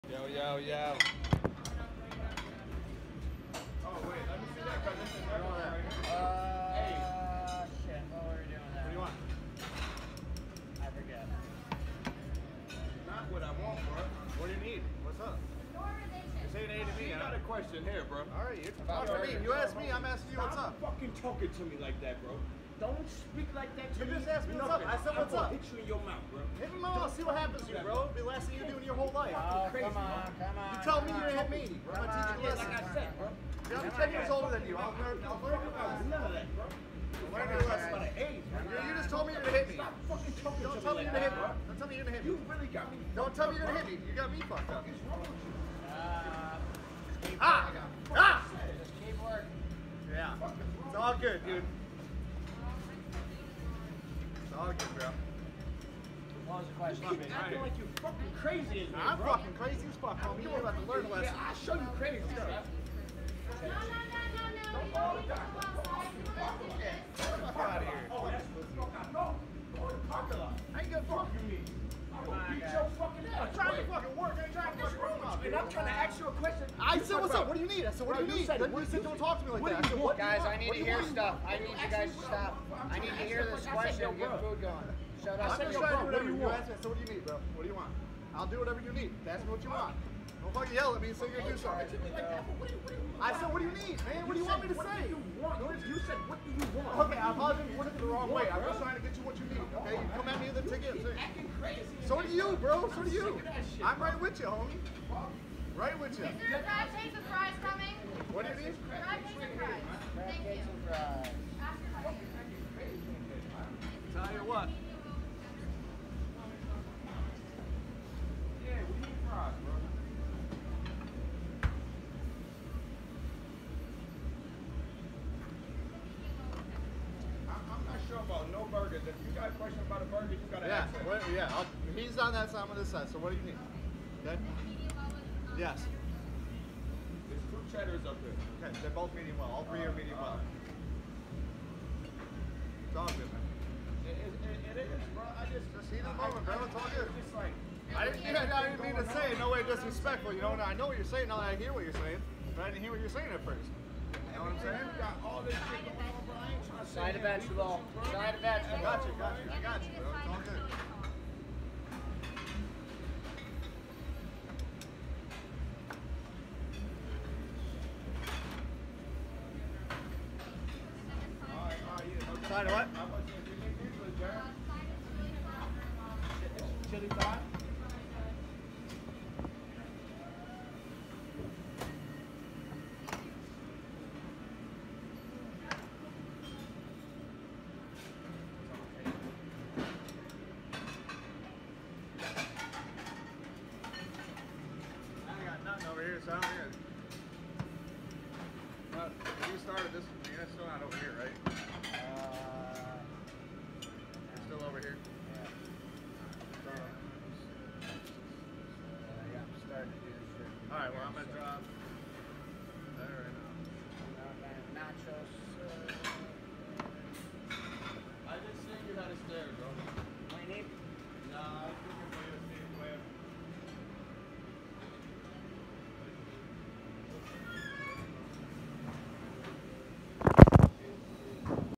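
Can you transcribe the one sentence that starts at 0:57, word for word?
keep acting like you're fucking crazy in I'm fucking crazy as fuck, homie.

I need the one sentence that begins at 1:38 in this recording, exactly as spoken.
I'm just trying to get you what you need, okay?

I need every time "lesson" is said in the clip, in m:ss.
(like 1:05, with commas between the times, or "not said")
0:32, 0:37, 1:01.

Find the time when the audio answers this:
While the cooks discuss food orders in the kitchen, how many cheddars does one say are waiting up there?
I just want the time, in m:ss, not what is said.
2:17.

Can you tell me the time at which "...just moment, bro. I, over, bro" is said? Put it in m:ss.
2:25.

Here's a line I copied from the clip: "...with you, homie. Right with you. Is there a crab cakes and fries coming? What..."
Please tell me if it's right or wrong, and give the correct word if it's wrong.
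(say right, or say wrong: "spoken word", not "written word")
right.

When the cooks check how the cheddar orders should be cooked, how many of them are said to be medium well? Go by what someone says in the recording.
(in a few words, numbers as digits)
3.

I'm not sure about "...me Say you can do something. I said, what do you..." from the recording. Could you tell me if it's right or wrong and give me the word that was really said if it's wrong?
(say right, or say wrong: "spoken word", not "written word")
right.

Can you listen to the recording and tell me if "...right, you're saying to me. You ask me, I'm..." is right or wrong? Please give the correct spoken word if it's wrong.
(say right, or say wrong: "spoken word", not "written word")
wrong: "talking", not "saying".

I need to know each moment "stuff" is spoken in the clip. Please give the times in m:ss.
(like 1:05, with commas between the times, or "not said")
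1:02, 1:21.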